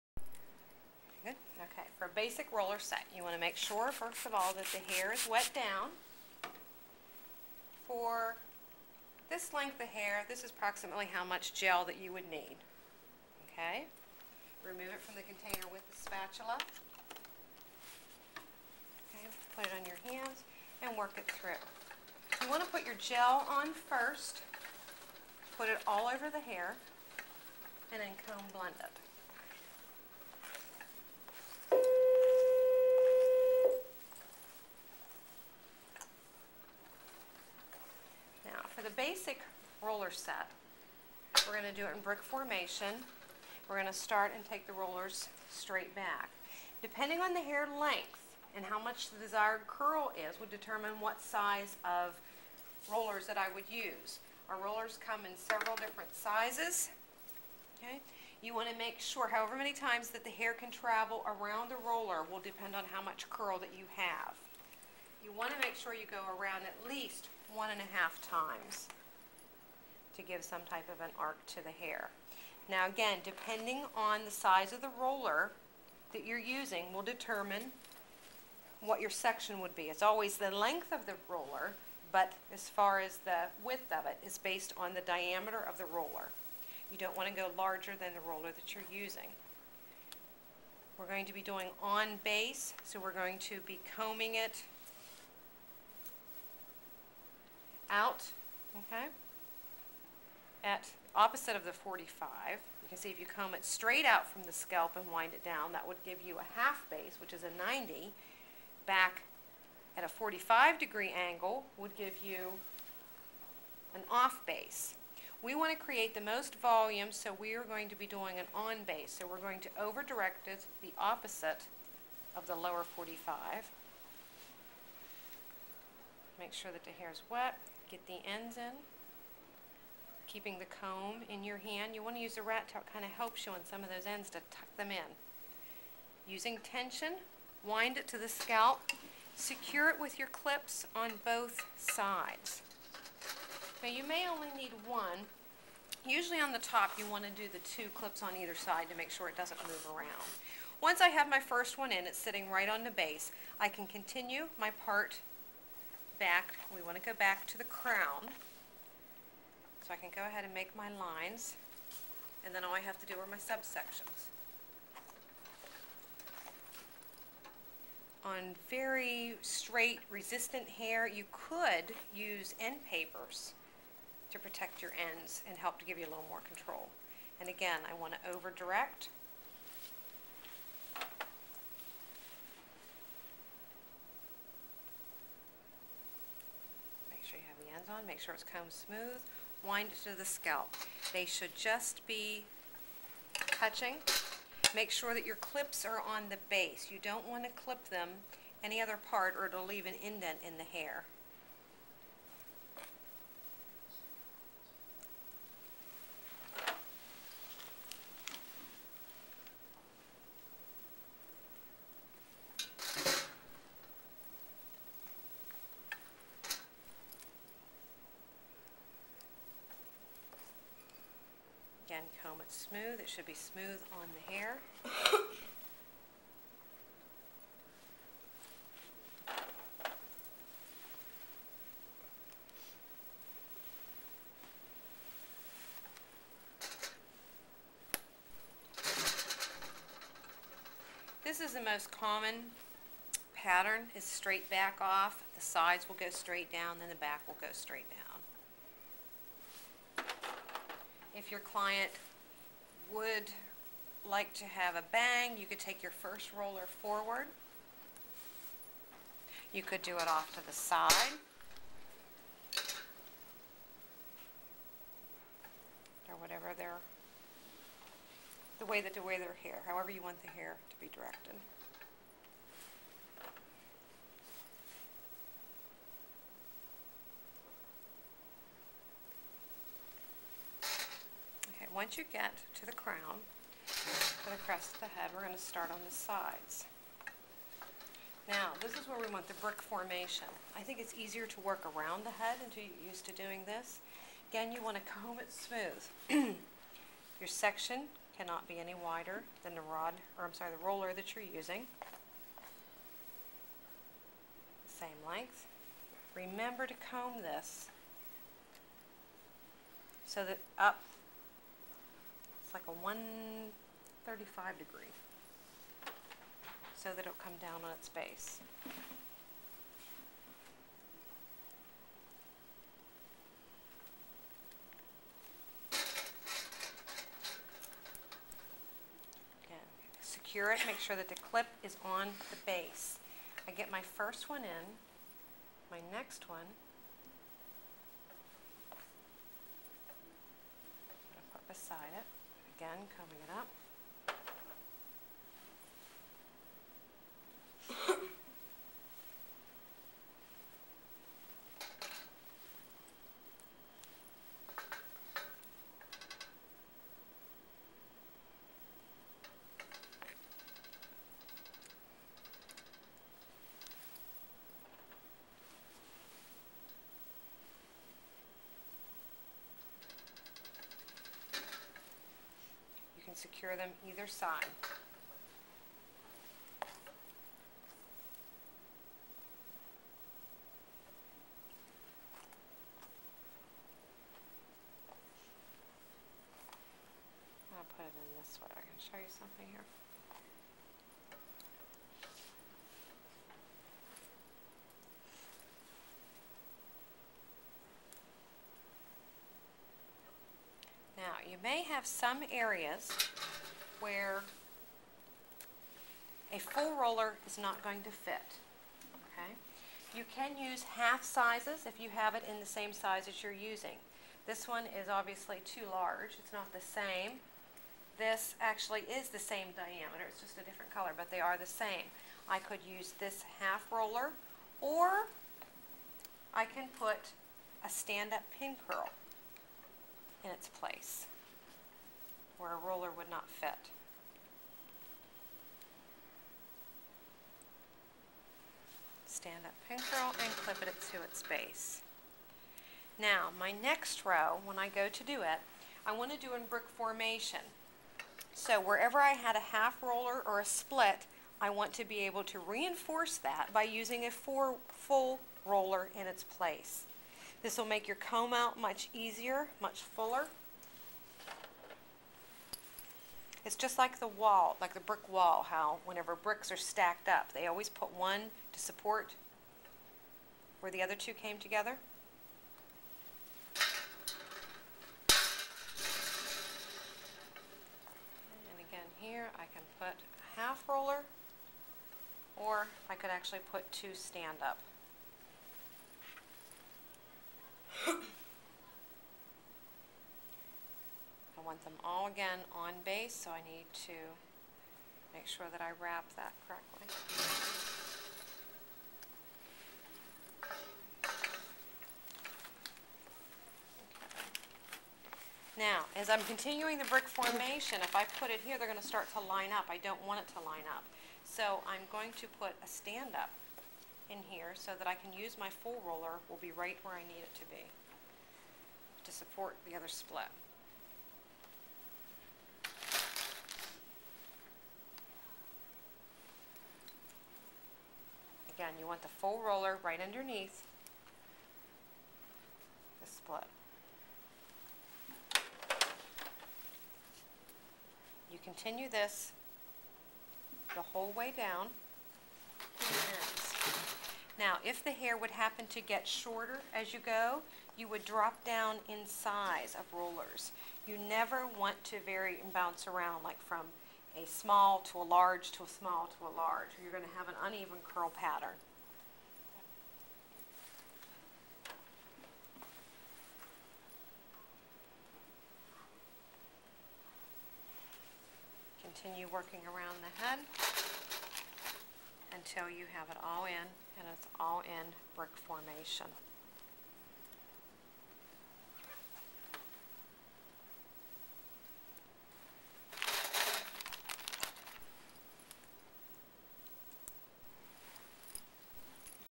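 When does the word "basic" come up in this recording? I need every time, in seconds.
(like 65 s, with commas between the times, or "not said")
2 s, 39 s.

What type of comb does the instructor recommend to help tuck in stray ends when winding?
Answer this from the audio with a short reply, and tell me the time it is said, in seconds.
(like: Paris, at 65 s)
rat tail, at 132 s.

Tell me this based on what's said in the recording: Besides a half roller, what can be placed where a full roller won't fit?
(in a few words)
stand-up pin curl.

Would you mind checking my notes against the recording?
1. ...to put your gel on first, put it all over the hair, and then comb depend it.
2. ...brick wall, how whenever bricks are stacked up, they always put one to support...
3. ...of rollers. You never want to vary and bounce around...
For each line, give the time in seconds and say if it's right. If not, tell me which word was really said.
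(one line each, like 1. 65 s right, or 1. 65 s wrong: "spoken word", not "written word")
1. 22 s wrong: "blend", not "depend"
2. 464 s right
3. 549 s right.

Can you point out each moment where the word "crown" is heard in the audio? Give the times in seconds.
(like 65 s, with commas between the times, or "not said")
157 s, 282 s.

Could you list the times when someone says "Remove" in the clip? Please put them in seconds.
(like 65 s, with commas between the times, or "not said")
14 s.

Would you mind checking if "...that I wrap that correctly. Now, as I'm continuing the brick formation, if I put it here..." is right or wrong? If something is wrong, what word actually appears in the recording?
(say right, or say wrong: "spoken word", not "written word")
right.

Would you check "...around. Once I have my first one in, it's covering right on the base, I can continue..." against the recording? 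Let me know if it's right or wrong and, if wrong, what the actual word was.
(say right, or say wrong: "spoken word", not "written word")
wrong: "sitting", not "covering".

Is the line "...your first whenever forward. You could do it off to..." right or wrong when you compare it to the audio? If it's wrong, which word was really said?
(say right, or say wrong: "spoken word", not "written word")
wrong: "roller", not "whenever".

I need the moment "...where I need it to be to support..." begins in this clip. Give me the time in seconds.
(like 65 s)
516 s.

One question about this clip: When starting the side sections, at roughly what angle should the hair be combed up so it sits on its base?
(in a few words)
135 degrees.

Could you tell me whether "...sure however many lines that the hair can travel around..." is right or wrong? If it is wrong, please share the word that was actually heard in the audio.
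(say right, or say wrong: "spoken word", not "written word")
wrong: "times", not "lines".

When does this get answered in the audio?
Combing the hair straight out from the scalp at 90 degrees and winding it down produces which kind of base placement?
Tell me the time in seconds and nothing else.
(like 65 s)
106 s.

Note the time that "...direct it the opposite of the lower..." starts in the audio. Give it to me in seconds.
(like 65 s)
120 s.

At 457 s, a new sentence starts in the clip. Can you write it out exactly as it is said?
This will make your comb out much easier, much fuller.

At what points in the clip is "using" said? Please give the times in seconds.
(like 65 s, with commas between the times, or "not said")
76 s, 89 s, 136 s, 301 s, 413 s, 453 s.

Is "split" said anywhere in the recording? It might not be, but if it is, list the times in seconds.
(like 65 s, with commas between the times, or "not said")
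450 s, 519 s, 533 s.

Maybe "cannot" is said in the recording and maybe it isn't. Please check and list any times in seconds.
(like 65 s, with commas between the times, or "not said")
298 s.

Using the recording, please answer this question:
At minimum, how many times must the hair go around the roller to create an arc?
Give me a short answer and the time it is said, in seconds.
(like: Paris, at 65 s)
1.5, at 67 s.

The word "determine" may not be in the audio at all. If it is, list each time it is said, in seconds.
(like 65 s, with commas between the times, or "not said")
50 s, 77 s.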